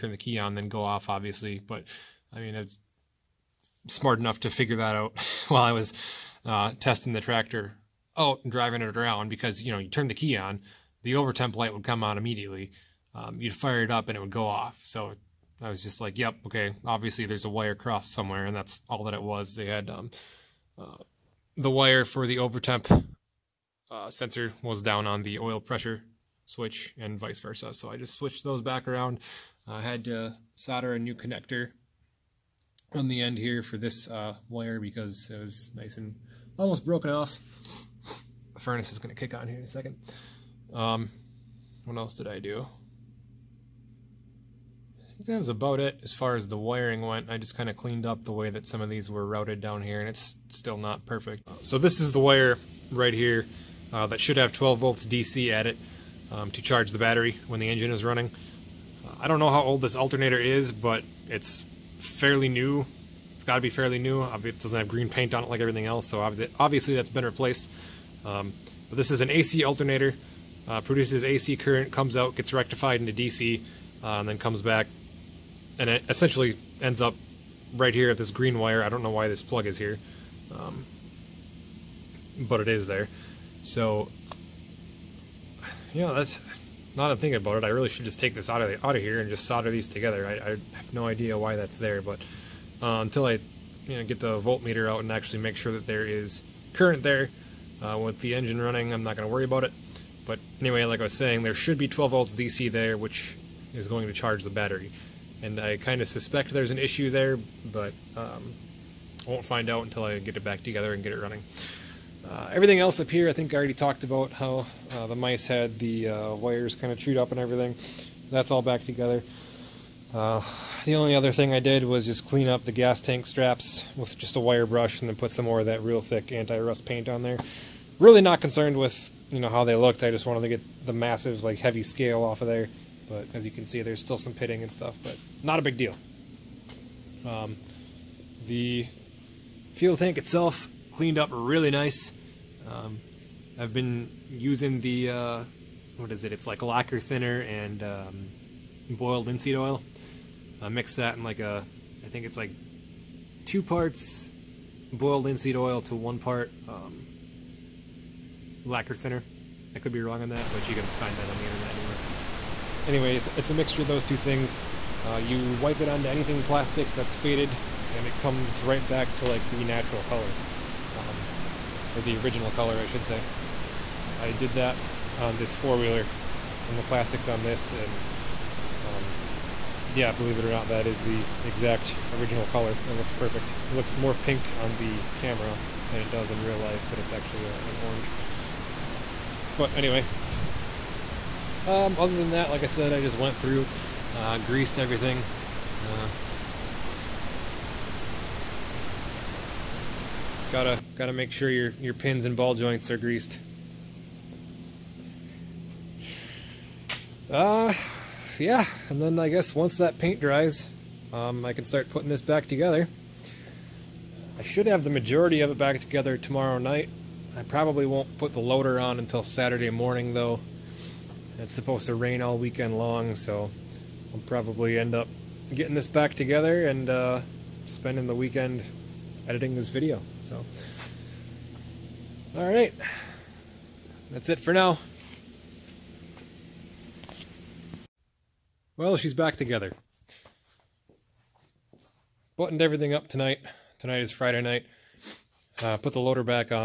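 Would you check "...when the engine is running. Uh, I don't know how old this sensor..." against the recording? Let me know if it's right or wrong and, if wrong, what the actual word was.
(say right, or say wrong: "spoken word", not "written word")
wrong: "alternator", not "sensor".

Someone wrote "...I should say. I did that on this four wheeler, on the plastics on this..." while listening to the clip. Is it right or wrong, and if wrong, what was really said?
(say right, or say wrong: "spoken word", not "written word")
right.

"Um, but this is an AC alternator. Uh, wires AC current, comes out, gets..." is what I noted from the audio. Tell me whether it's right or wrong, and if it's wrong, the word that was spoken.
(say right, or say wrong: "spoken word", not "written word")
wrong: "produces", not "wires".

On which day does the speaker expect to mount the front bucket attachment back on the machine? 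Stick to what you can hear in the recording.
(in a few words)
Saturday morning.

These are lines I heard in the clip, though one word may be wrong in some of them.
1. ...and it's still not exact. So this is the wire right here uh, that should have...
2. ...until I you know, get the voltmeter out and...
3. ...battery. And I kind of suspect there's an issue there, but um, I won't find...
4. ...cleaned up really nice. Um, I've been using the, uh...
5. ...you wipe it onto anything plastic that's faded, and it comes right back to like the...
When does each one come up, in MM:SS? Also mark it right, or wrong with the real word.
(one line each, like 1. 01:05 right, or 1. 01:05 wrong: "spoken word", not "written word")
1. 00:49 wrong: "perfect", not "exact"
2. 01:33 right
3. 01:44 right
4. 02:20 right
5. 02:45 right.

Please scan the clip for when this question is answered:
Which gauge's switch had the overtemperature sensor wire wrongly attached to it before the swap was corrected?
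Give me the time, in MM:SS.
00:25.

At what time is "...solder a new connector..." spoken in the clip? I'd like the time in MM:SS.
00:30.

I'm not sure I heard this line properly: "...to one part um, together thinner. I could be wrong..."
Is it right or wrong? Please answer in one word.
wrong.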